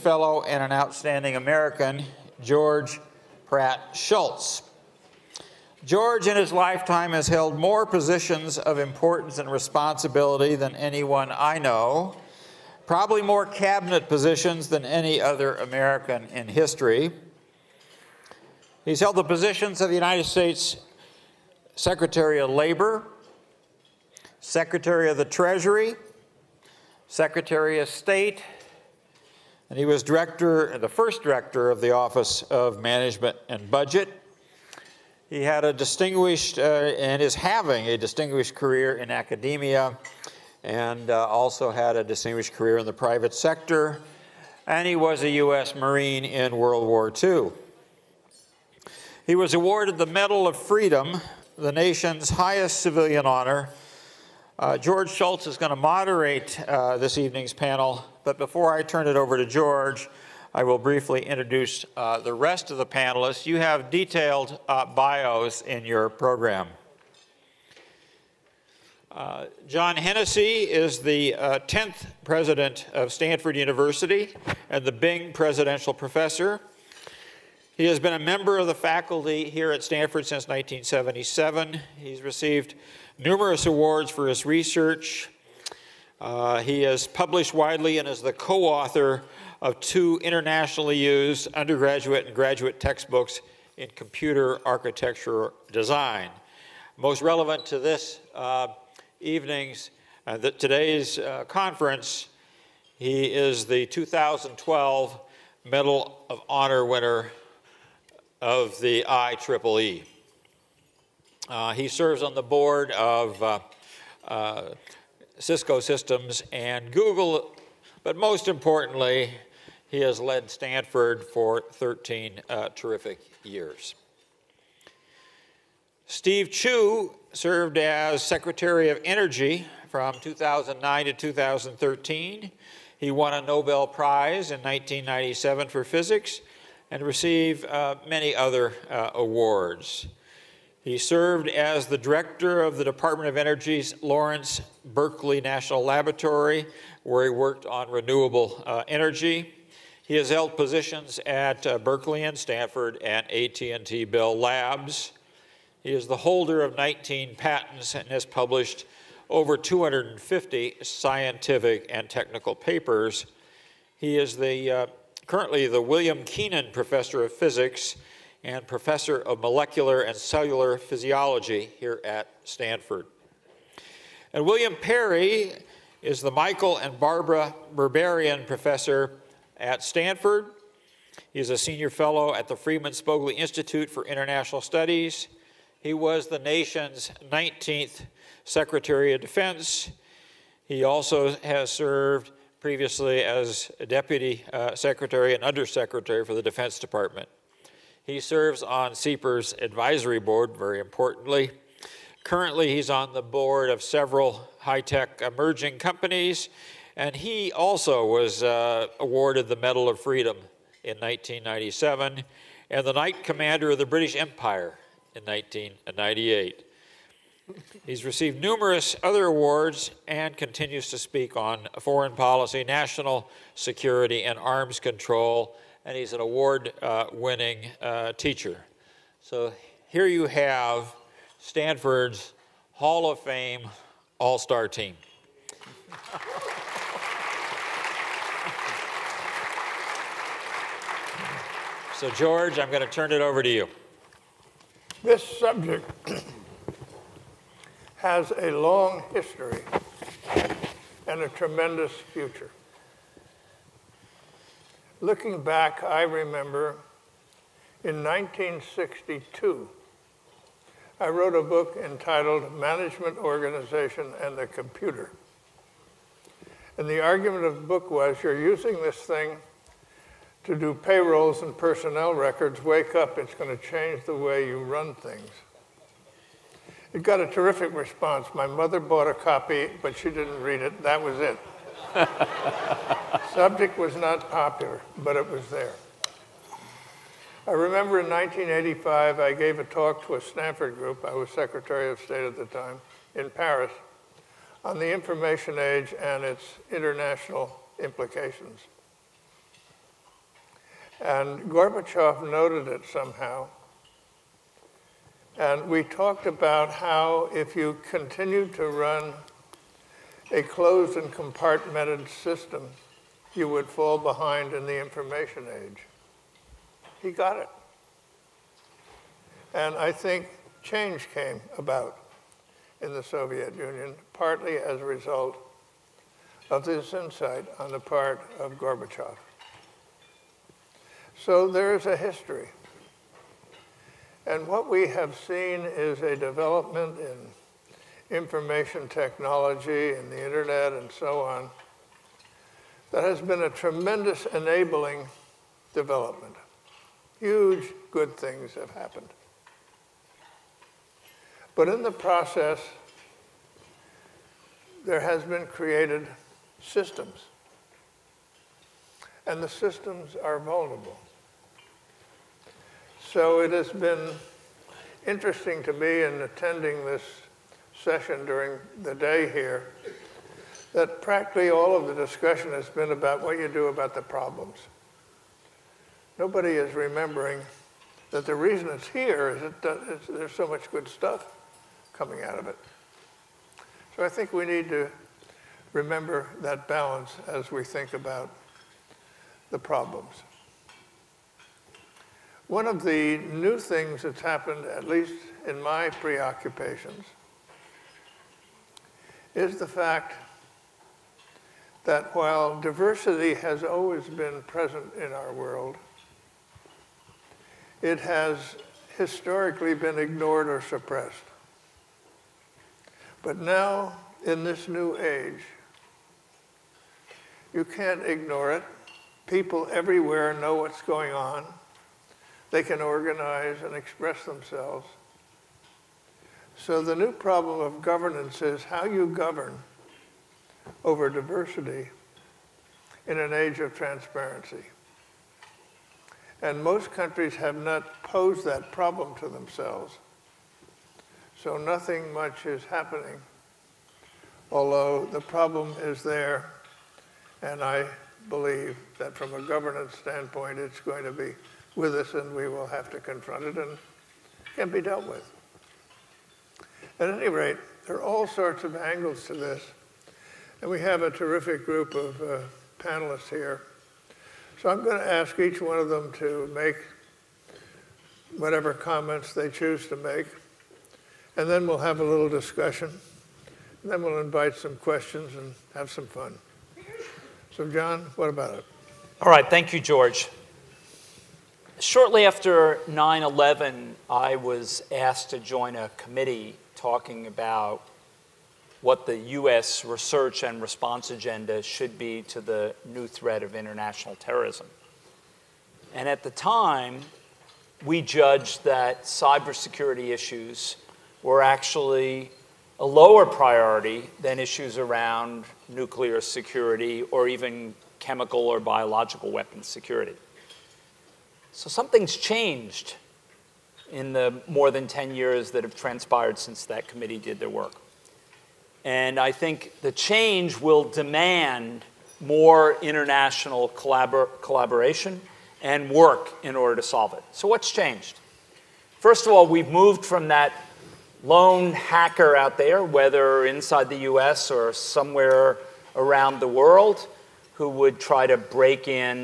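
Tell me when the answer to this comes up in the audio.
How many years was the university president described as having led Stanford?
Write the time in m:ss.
2:01.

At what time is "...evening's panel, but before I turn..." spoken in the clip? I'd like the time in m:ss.
0:57.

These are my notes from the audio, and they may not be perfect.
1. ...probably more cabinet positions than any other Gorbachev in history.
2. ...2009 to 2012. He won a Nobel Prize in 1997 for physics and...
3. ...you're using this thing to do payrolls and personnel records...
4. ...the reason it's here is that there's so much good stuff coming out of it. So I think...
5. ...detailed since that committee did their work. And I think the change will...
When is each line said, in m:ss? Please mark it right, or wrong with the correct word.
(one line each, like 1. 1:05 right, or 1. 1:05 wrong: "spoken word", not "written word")
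1. 0:12 wrong: "American", not "Gorbachev"
2. 2:10 wrong: "2013", not "2012"
3. 4:28 right
4. 6:18 right
5. 8:35 wrong: "transpired", not "detailed".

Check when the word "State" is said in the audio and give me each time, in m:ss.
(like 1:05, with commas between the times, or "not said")
0:20, 0:27, 4:51.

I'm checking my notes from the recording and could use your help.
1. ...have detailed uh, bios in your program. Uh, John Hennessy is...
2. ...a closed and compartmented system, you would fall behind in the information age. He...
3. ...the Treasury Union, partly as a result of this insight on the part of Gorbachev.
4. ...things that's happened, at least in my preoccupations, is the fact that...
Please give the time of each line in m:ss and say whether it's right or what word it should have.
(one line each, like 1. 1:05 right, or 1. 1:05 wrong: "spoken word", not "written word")
1. 1:03 right
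2. 5:10 right
3. 5:22 wrong: "Soviet", not "Treasury"
4. 6:33 right.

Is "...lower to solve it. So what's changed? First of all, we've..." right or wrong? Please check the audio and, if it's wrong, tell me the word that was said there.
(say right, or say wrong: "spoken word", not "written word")
wrong: "order", not "lower".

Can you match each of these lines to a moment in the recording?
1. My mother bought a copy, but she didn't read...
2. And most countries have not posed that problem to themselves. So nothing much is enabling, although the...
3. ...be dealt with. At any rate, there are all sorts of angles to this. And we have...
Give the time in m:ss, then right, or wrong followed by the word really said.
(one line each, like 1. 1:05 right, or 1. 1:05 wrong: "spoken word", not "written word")
1. 4:38 right
2. 7:16 wrong: "happening", not "enabling"
3. 7:34 right.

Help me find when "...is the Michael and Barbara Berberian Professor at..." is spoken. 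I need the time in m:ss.
2:56.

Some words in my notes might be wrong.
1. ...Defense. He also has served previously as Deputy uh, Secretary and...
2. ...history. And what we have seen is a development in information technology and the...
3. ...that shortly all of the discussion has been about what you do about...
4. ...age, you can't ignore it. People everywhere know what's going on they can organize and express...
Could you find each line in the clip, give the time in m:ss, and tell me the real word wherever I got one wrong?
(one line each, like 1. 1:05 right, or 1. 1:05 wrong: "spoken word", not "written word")
1. 3:09 right
2. 5:31 right
3. 6:10 wrong: "practically", not "shortly"
4. 6:54 right.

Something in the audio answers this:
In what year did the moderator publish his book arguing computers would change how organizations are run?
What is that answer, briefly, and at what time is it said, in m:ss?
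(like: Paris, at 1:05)
1962, at 4:18.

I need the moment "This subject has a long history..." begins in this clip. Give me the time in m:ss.
4:05.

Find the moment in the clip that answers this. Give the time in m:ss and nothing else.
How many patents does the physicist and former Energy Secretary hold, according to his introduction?
2:36.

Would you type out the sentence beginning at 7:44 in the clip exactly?
So I'm going to ask each one of them to make whatever comments they choose to make.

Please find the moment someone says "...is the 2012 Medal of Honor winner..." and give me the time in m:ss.
1:43.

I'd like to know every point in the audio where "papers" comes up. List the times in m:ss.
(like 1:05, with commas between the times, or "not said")
2:42.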